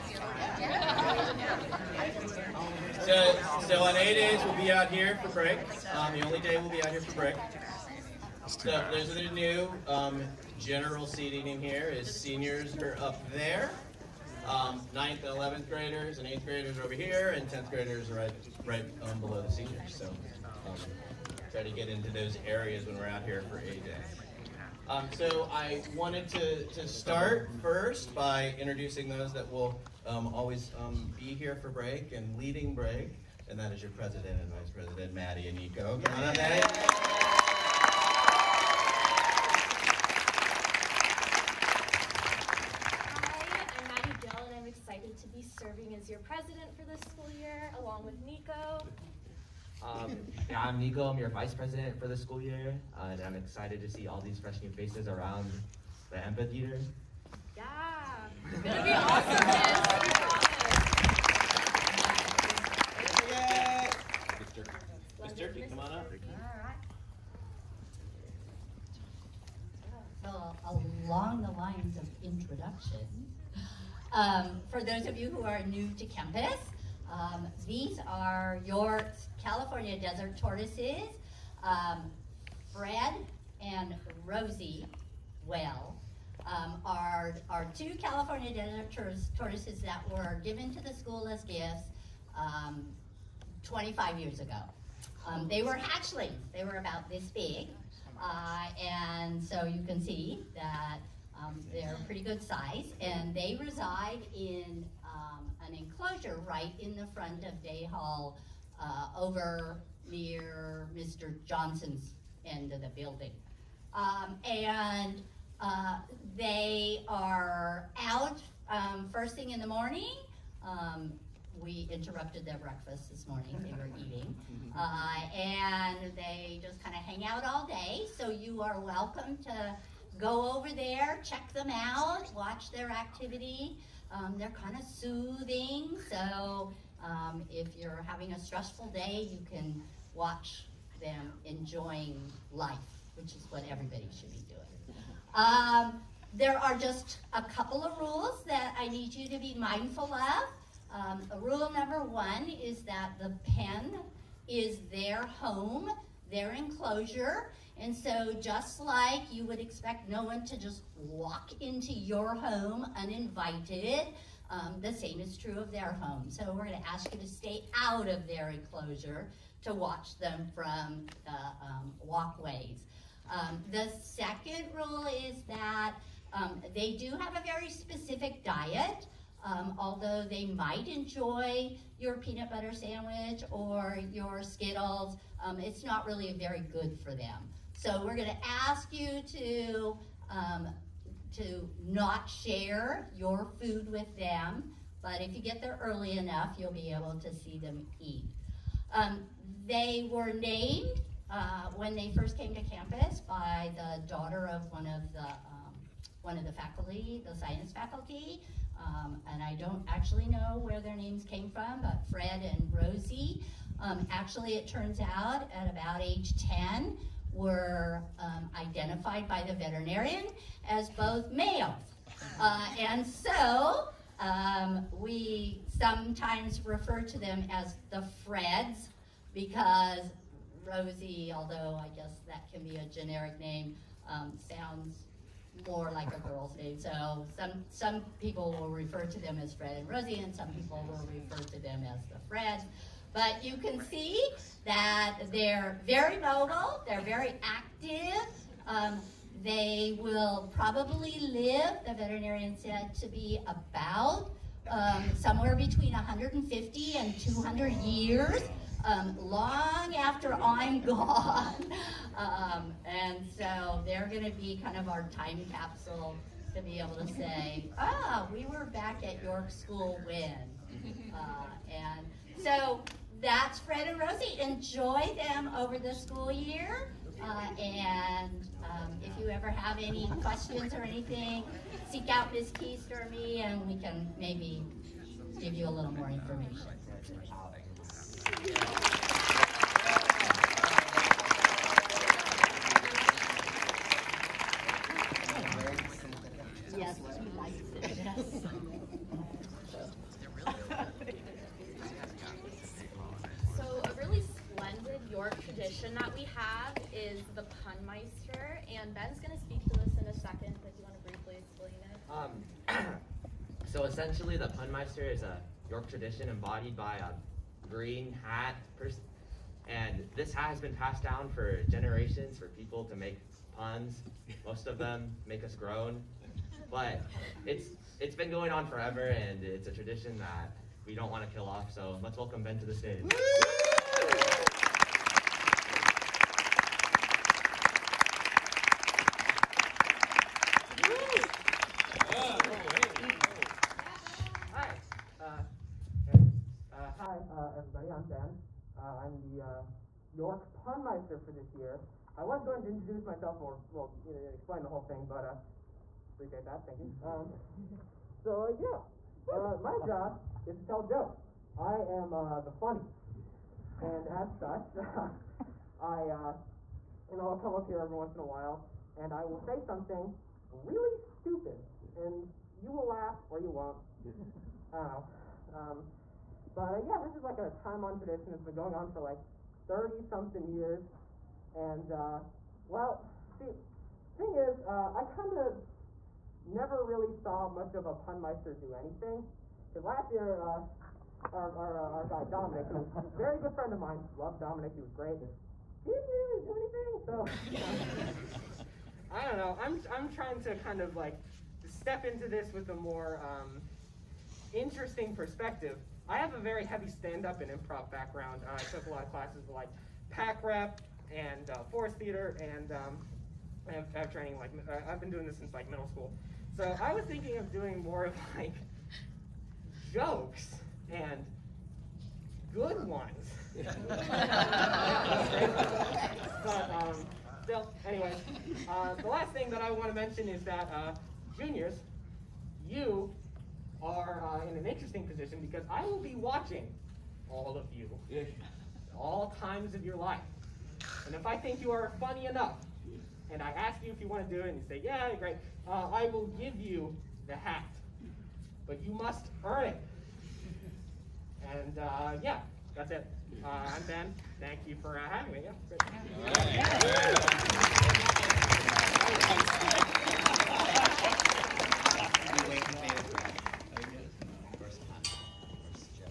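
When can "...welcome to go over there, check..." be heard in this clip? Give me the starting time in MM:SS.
02:08.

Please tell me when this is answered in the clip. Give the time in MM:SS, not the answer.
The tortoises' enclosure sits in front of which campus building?
01:47.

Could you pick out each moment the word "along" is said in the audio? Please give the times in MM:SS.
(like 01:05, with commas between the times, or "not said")
00:47, 01:11.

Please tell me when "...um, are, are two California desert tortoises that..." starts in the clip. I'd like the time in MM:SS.
01:26.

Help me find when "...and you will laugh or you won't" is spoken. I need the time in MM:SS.
06:12.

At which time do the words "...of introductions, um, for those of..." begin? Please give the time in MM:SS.
01:11.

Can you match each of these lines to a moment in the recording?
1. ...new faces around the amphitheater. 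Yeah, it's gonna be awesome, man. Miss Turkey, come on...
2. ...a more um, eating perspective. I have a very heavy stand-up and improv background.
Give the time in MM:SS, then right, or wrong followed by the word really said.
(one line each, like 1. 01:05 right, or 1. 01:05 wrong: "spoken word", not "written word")
1. 00:54 right
2. 06:42 wrong: "interesting", not "eating".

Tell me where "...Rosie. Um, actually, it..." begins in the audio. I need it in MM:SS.
03:32.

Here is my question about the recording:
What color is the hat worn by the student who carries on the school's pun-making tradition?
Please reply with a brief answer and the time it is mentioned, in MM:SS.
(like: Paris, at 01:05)
green, at 05:17.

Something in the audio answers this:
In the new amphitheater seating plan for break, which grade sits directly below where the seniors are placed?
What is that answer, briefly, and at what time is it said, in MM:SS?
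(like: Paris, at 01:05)
tenth graders, at 00:17.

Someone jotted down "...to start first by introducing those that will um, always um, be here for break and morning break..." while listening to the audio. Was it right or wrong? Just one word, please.
wrong.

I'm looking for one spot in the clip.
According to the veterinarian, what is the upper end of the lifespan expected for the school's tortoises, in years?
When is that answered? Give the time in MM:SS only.
04:17.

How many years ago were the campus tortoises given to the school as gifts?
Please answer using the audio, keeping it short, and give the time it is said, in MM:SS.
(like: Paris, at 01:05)
25, at 01:33.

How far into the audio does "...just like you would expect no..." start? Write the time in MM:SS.
02:38.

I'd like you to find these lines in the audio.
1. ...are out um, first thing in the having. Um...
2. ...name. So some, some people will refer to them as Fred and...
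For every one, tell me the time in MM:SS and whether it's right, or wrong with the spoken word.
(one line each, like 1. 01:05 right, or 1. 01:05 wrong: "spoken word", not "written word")
1. 01:57 wrong: "morning", not "having"
2. 03:56 right.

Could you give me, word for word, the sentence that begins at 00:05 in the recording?
Um, the only day we'll be out here for break.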